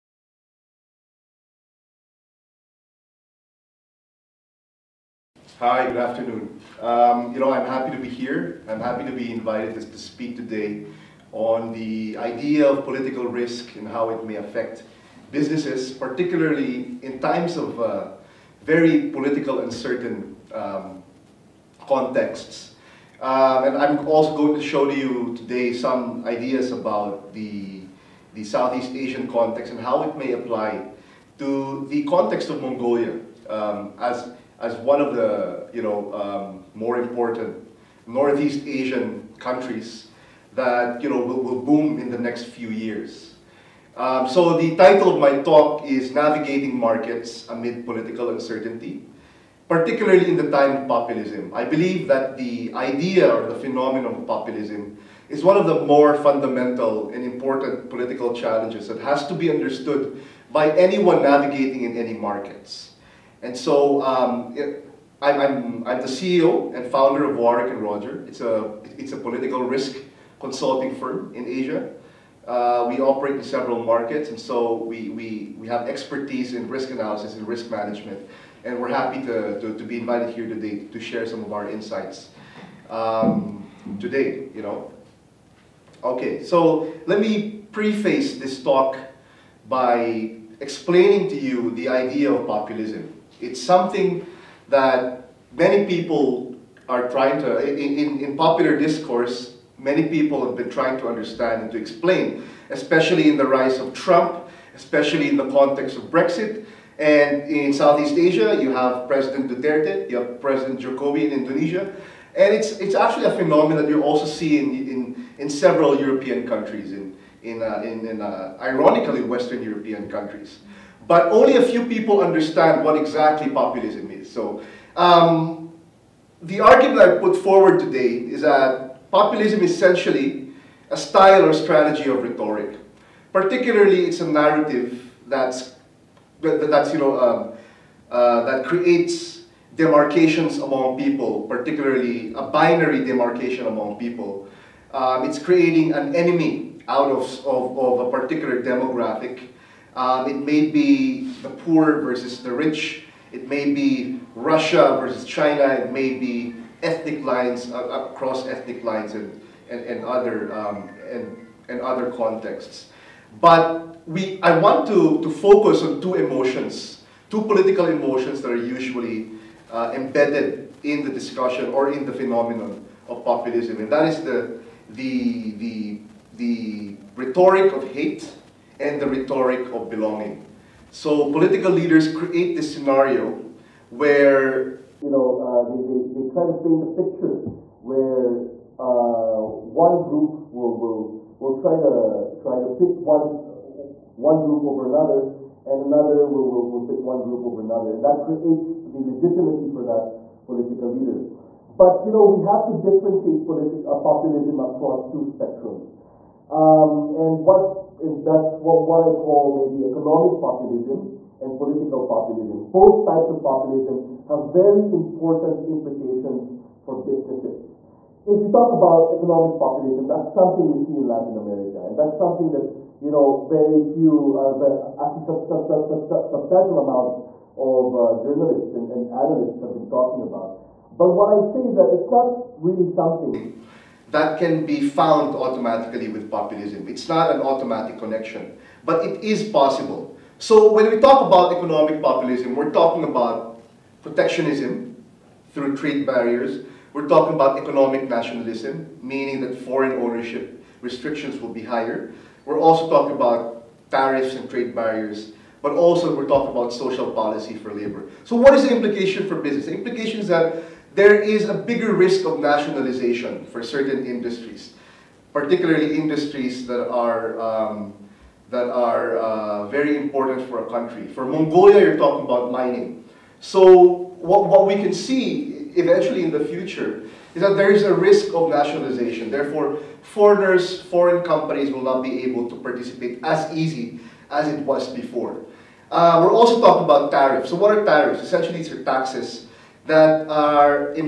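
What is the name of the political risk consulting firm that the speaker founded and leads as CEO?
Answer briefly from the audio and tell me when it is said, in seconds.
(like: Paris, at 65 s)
Warwick and Roger, at 67 s.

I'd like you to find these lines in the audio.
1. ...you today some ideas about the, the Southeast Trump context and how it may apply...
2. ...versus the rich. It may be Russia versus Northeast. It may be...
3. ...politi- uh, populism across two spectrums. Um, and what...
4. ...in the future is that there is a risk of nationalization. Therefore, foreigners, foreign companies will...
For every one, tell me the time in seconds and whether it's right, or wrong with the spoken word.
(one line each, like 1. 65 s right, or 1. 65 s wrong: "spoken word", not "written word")
1. 24 s wrong: "Asian", not "Trump"
2. 151 s wrong: "China", not "Northeast"
3. 203 s right
4. 276 s right.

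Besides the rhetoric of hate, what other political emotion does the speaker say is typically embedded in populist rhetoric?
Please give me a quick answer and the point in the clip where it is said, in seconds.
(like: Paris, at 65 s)
belonging, at 178 s.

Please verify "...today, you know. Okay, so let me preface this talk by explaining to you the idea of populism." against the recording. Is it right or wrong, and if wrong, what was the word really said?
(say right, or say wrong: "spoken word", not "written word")
right.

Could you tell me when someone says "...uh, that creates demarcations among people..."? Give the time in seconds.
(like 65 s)
138 s.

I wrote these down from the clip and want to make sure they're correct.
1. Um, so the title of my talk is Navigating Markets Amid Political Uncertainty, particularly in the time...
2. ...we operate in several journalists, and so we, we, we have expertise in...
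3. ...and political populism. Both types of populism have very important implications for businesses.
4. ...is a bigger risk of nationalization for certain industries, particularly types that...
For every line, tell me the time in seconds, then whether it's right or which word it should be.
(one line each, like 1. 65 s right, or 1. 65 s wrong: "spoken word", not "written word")
1. 43 s right
2. 72 s wrong: "markets", not "journalists"
3. 211 s right
4. 261 s wrong: "industries", not "types".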